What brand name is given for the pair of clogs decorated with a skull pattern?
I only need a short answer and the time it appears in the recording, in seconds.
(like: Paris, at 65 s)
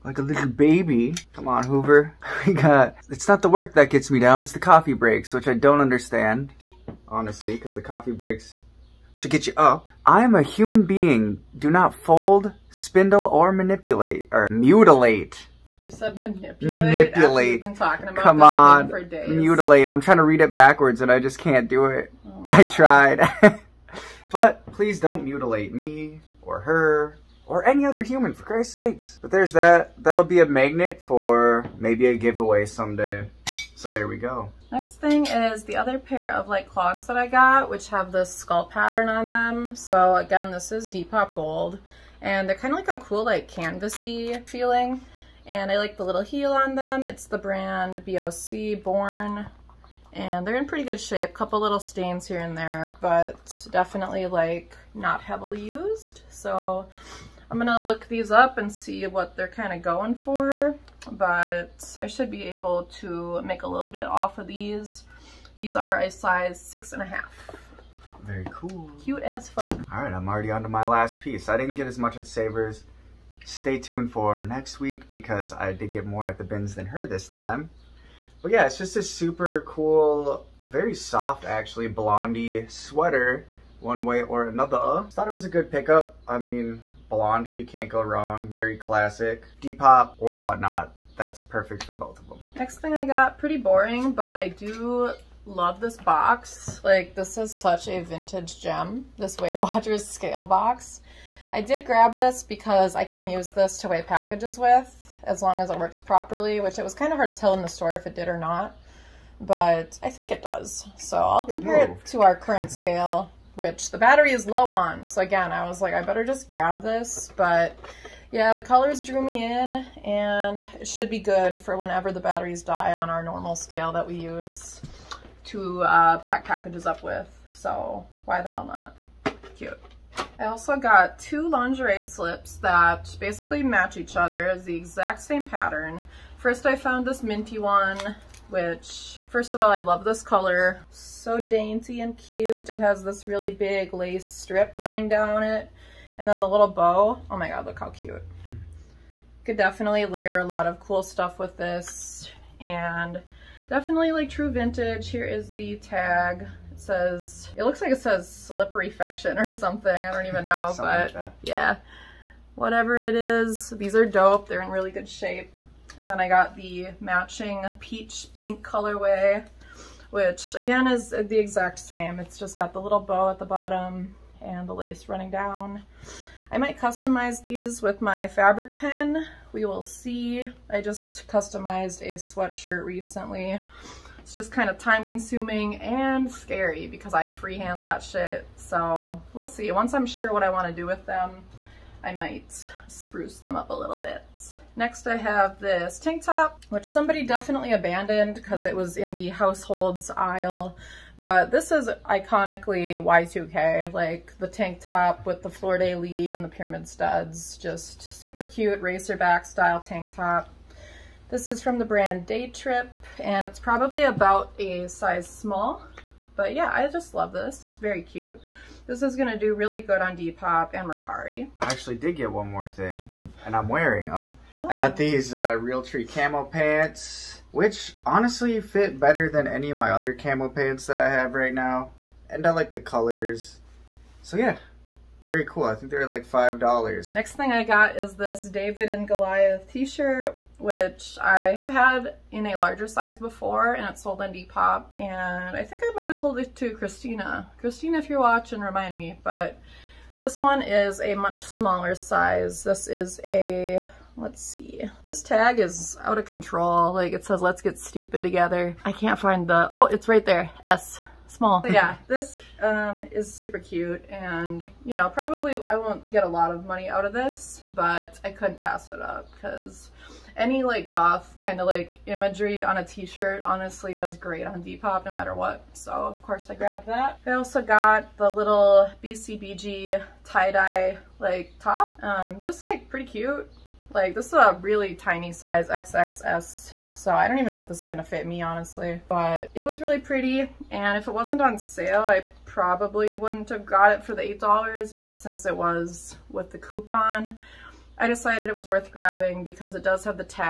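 BOC Born, at 48 s.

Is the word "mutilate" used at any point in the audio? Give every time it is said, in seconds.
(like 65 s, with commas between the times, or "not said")
14 s, 19 s, 25 s.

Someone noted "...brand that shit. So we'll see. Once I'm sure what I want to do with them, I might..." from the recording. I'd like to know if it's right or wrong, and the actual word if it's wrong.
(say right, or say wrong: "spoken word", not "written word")
wrong: "freehand", not "brand".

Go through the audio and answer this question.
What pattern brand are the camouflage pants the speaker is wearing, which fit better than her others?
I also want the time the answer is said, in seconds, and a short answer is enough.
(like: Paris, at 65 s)
Realtree, at 225 s.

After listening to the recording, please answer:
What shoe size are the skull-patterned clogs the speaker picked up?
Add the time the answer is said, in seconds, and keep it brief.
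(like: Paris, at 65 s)
6.5, at 66 s.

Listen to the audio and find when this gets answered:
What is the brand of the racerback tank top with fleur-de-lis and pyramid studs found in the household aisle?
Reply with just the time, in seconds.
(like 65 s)
212 s.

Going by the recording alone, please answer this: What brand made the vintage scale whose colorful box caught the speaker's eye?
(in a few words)
Weight Watchers.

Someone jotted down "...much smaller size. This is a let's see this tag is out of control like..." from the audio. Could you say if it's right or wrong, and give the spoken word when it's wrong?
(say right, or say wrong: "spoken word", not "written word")
right.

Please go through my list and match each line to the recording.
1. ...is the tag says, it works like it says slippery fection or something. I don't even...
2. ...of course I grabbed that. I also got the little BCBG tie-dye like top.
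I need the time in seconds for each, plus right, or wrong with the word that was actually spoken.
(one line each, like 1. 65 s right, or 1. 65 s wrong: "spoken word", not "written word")
1. 155 s wrong: "looks", not "works"
2. 275 s right.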